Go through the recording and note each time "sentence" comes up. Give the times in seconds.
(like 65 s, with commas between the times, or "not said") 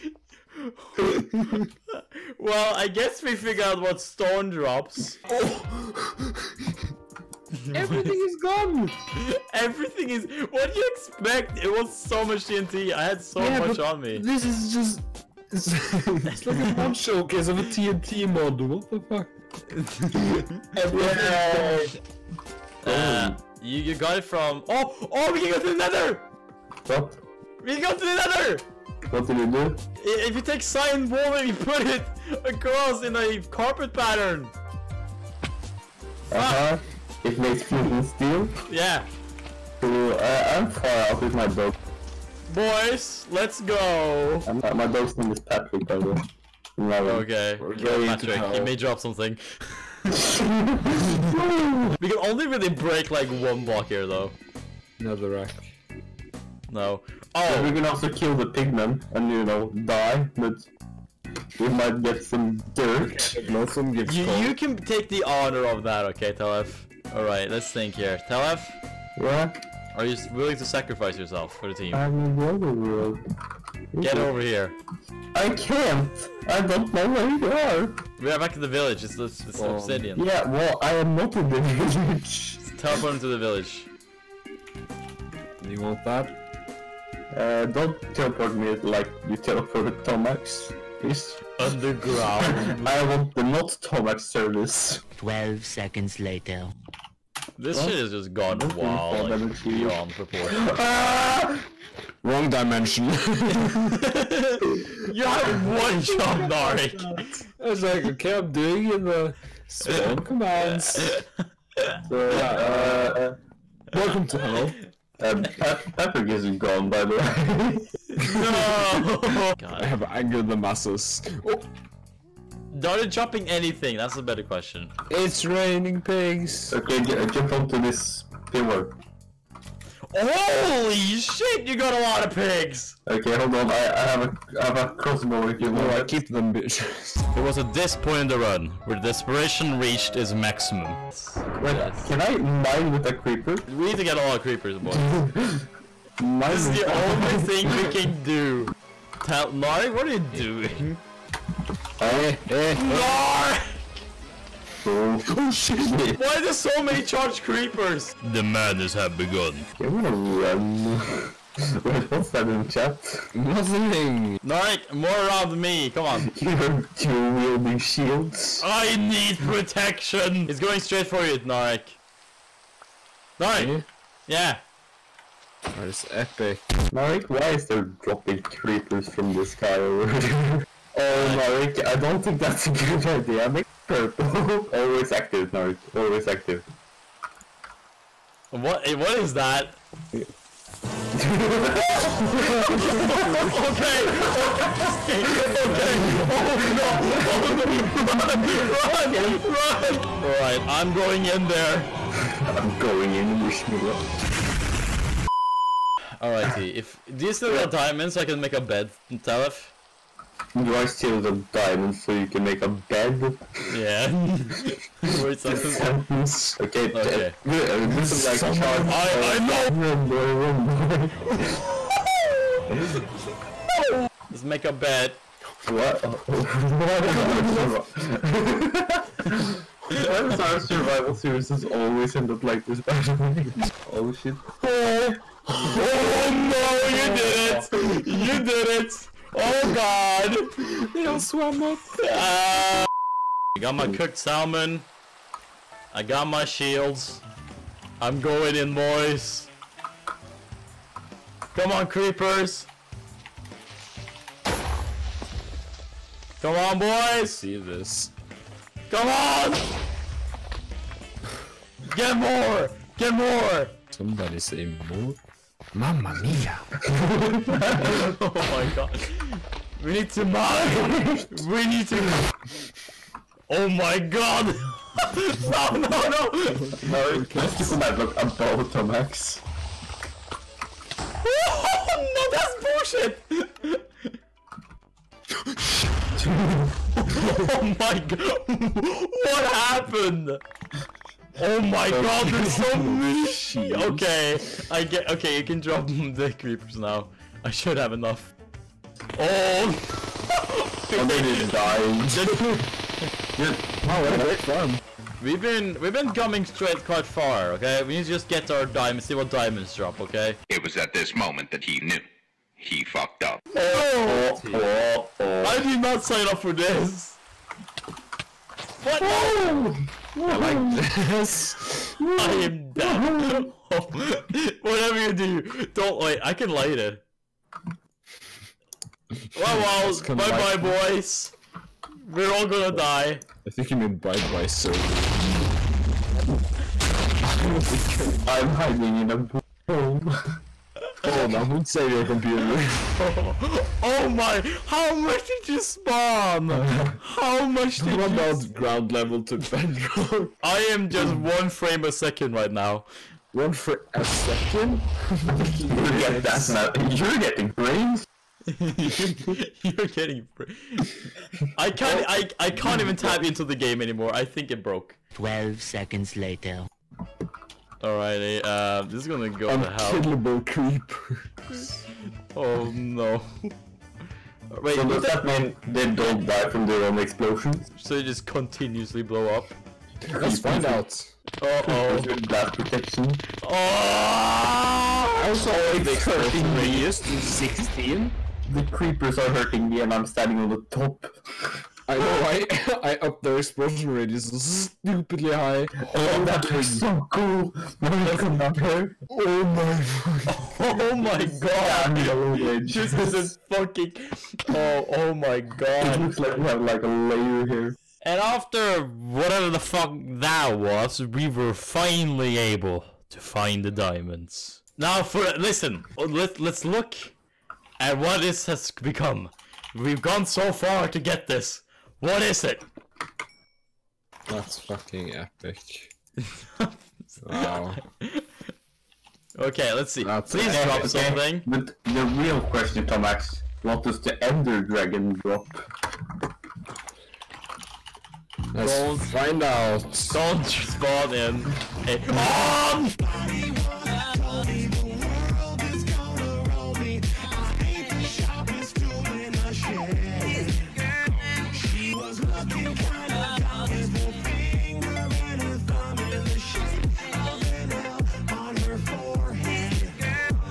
215 s.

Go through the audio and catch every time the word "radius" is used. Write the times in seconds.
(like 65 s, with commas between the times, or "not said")
386 s, 393 s.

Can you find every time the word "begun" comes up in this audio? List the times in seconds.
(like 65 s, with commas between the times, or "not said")
159 s.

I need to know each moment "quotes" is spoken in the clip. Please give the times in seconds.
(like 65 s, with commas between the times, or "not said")
not said.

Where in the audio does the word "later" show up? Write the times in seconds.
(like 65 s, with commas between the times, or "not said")
96 s, 366 s.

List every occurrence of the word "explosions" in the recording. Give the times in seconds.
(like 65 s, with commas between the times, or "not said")
376 s, 393 s.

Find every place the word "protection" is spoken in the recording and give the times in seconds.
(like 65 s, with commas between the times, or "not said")
169 s, 382 s.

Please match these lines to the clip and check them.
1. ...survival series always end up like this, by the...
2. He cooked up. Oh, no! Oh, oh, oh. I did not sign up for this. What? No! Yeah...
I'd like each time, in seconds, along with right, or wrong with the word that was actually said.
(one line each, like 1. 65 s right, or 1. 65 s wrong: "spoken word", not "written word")
1. 230 s right
2. 312 s wrong: "fucked", not "cooked".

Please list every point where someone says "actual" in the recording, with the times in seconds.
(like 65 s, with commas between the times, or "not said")
not said.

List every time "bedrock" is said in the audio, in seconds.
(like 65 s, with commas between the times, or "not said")
349 s.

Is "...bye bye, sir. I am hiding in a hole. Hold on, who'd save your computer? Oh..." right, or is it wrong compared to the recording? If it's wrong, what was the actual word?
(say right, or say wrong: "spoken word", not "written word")
right.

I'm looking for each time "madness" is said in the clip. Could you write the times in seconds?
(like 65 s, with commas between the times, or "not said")
158 s.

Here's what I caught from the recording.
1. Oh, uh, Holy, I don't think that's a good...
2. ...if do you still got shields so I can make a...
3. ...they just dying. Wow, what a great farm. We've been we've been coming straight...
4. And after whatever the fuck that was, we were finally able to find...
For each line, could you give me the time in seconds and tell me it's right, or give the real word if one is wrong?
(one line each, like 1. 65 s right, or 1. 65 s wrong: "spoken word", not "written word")
1. 180 s wrong: "Norik", not "Holy"
2. 206 s wrong: "diamonds", not "shields"
3. 301 s right
4. 408 s right.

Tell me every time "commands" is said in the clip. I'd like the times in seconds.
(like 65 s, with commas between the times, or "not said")
110 s, 277 s.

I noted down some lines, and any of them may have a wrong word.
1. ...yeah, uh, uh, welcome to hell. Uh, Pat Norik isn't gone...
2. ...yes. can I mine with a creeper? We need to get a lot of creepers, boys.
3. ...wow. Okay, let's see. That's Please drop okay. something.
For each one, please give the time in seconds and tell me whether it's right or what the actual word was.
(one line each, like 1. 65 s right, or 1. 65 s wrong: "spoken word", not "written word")
1. 112 s wrong: "Patrick", not "Norik"
2. 141 s right
3. 427 s right.